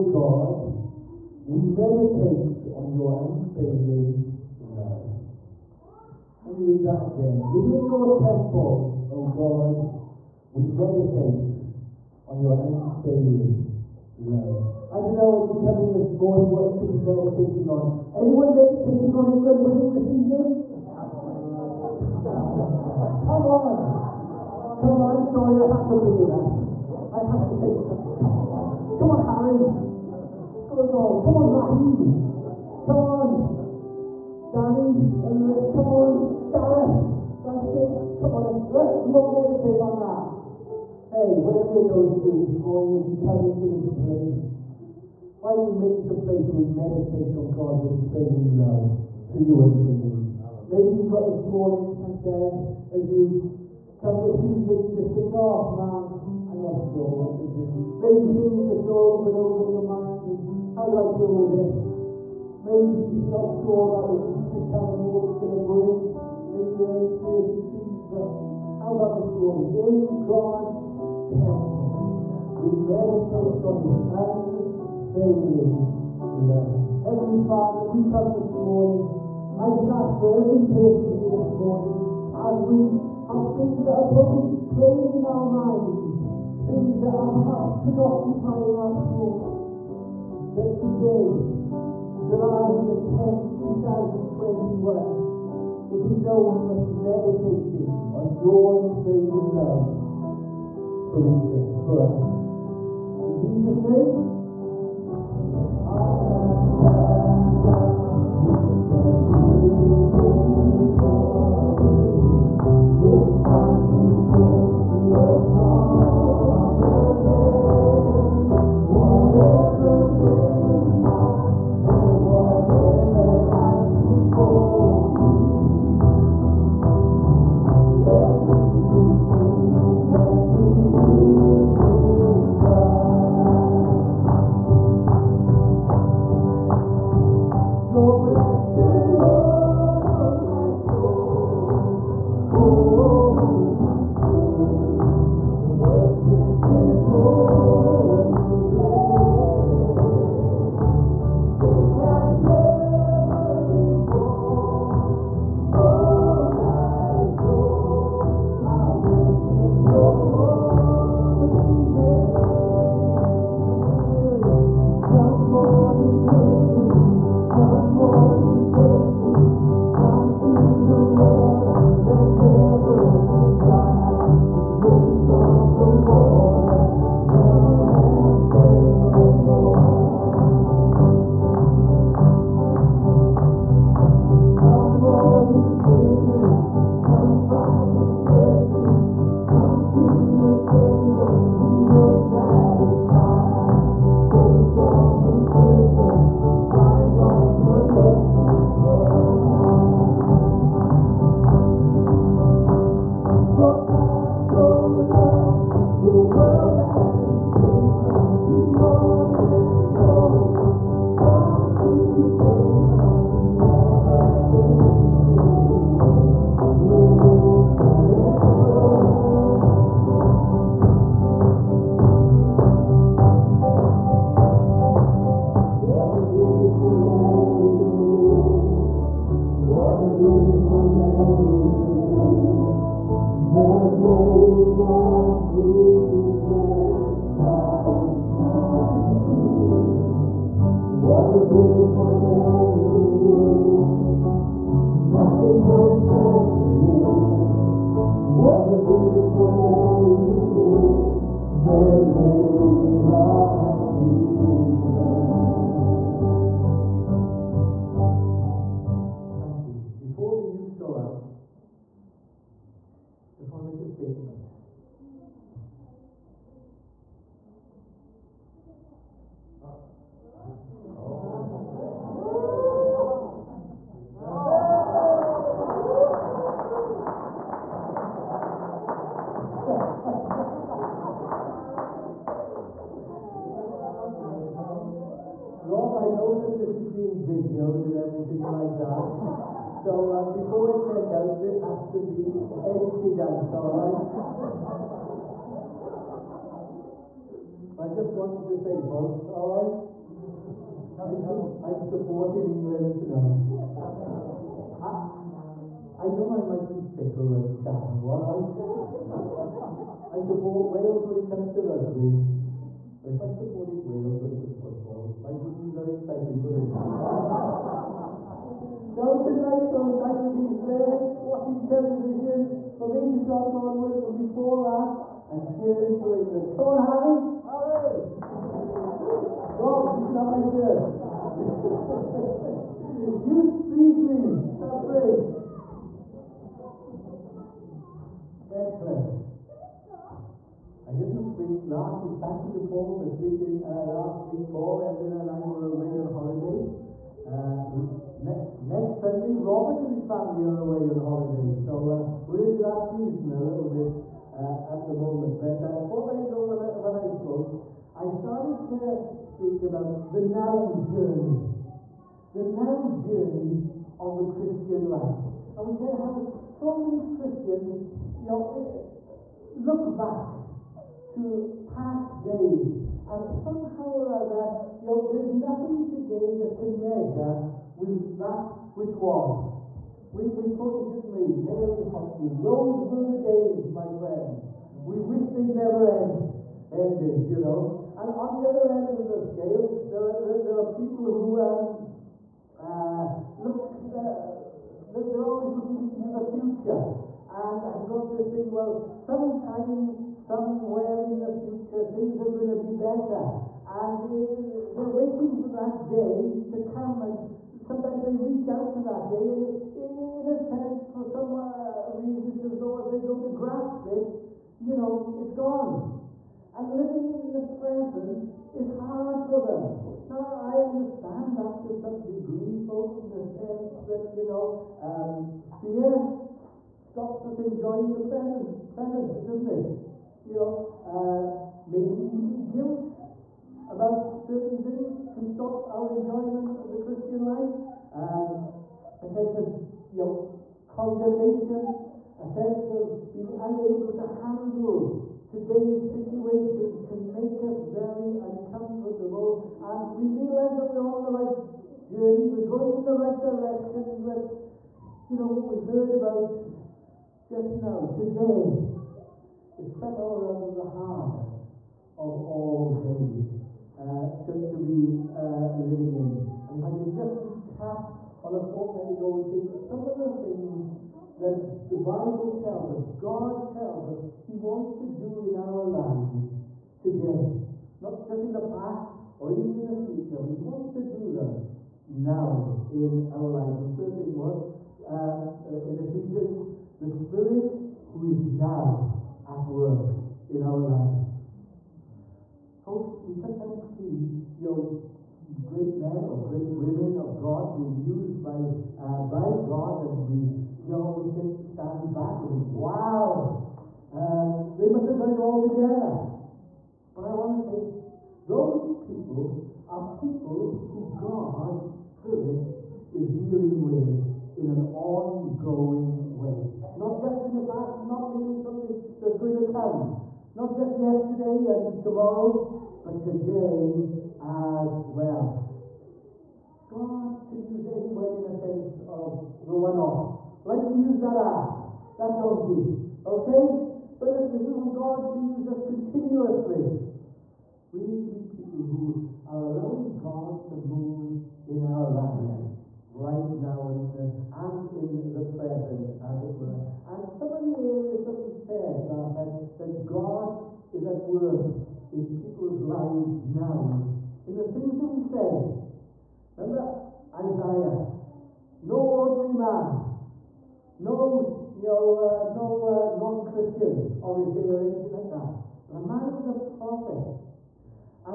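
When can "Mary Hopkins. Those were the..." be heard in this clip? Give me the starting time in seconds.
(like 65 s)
381 s.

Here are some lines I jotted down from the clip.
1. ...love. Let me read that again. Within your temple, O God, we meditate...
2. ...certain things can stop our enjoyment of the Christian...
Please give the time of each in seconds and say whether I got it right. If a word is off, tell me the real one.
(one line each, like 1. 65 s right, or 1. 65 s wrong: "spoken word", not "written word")
1. 4 s right
2. 434 s right.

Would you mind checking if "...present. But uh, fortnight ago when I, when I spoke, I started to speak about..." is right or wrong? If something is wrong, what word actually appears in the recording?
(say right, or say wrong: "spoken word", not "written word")
wrong: "moment", not "present".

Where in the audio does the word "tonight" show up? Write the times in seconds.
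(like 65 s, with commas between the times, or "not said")
302 s, 319 s.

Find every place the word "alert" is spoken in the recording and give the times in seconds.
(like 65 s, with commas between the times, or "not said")
not said.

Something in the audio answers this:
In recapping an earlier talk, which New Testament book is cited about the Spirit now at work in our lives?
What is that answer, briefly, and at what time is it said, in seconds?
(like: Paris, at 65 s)
Ephesians, at 485 s.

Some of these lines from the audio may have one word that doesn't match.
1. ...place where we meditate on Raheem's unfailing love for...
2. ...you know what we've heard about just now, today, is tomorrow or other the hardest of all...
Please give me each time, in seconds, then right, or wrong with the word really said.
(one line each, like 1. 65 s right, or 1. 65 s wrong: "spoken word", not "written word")
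1. 46 s wrong: "God", not "Raheem"
2. 455 s wrong: "somehow", not "tomorrow".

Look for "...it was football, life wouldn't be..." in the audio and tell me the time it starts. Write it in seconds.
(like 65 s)
314 s.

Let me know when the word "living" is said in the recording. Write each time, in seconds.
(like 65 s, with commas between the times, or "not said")
416 s, 465 s.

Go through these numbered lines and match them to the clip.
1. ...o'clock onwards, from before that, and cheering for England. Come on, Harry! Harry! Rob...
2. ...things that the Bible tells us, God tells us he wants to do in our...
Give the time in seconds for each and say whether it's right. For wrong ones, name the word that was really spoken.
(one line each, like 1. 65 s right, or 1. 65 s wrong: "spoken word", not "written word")
1. 323 s right
2. 470 s right.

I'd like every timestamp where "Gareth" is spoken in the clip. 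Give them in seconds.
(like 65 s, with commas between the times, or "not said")
36 s.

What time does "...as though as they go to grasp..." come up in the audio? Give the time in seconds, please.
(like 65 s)
412 s.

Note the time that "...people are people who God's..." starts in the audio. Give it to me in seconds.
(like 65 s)
508 s.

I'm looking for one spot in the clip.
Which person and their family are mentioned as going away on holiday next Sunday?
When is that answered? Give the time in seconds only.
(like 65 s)
349 s.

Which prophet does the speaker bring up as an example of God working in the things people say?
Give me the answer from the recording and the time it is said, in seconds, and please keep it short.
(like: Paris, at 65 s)
Isaiah, at 557 s.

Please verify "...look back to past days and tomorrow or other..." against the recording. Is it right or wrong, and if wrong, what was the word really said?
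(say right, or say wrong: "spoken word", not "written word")
wrong: "somehow", not "tomorrow".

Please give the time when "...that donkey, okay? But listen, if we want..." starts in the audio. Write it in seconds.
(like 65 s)
531 s.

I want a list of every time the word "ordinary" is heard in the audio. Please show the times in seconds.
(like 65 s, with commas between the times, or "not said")
558 s.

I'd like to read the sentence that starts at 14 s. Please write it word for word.
I don't know as you come in this morning what you could be meditating on.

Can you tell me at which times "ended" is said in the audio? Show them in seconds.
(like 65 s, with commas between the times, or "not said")
386 s.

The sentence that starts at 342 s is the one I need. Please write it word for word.
Thank you to Paul for speaking uh, last week.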